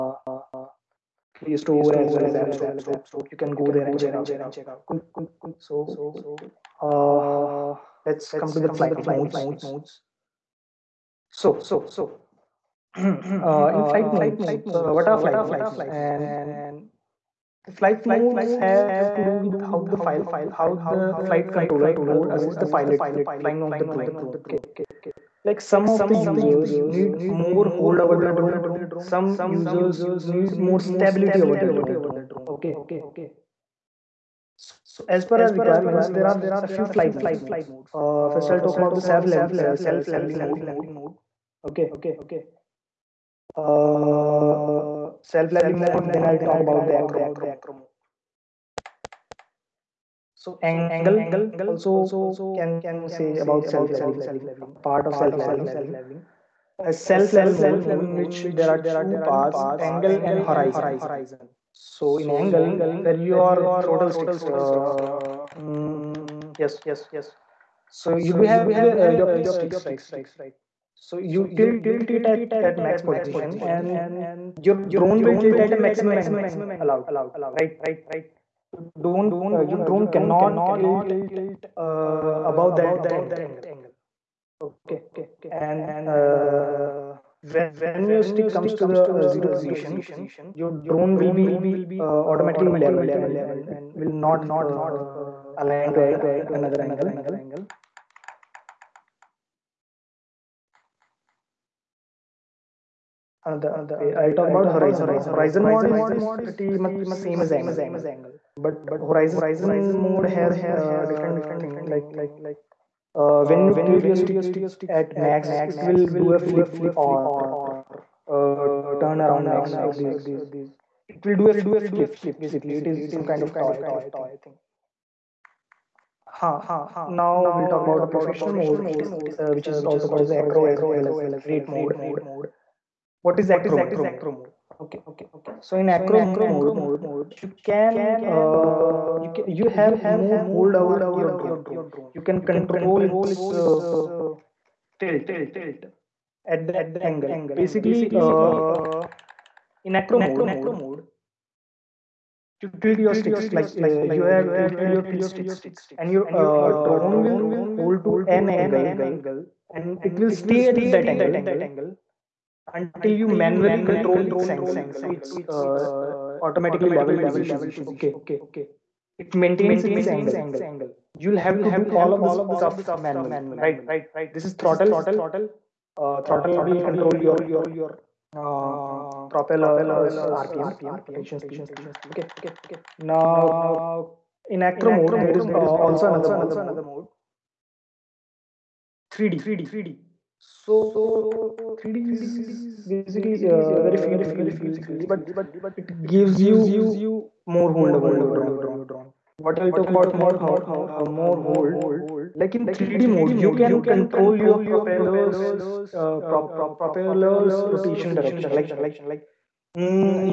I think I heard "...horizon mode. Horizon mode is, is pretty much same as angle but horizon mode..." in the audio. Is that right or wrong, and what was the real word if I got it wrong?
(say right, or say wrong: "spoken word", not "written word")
right.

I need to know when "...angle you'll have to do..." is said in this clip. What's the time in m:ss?
2:50.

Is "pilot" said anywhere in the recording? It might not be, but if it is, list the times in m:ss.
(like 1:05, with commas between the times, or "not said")
0:22.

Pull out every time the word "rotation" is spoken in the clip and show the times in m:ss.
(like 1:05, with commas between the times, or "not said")
3:01, 3:27.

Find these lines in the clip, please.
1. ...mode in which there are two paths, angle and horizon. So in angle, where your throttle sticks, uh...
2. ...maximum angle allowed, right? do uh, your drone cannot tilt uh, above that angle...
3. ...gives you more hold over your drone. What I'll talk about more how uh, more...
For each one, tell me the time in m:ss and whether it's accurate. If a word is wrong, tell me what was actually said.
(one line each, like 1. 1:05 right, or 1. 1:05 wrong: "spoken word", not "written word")
1. 0:57 right
2. 1:15 right
3. 3:16 right.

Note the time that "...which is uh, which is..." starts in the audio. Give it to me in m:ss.
2:08.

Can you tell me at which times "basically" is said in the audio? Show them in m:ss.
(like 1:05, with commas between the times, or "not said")
2:02, 2:27, 3:12.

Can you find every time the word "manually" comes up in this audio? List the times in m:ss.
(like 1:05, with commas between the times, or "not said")
2:43, 2:53.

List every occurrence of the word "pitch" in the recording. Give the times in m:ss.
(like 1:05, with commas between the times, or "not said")
1:09, 2:35.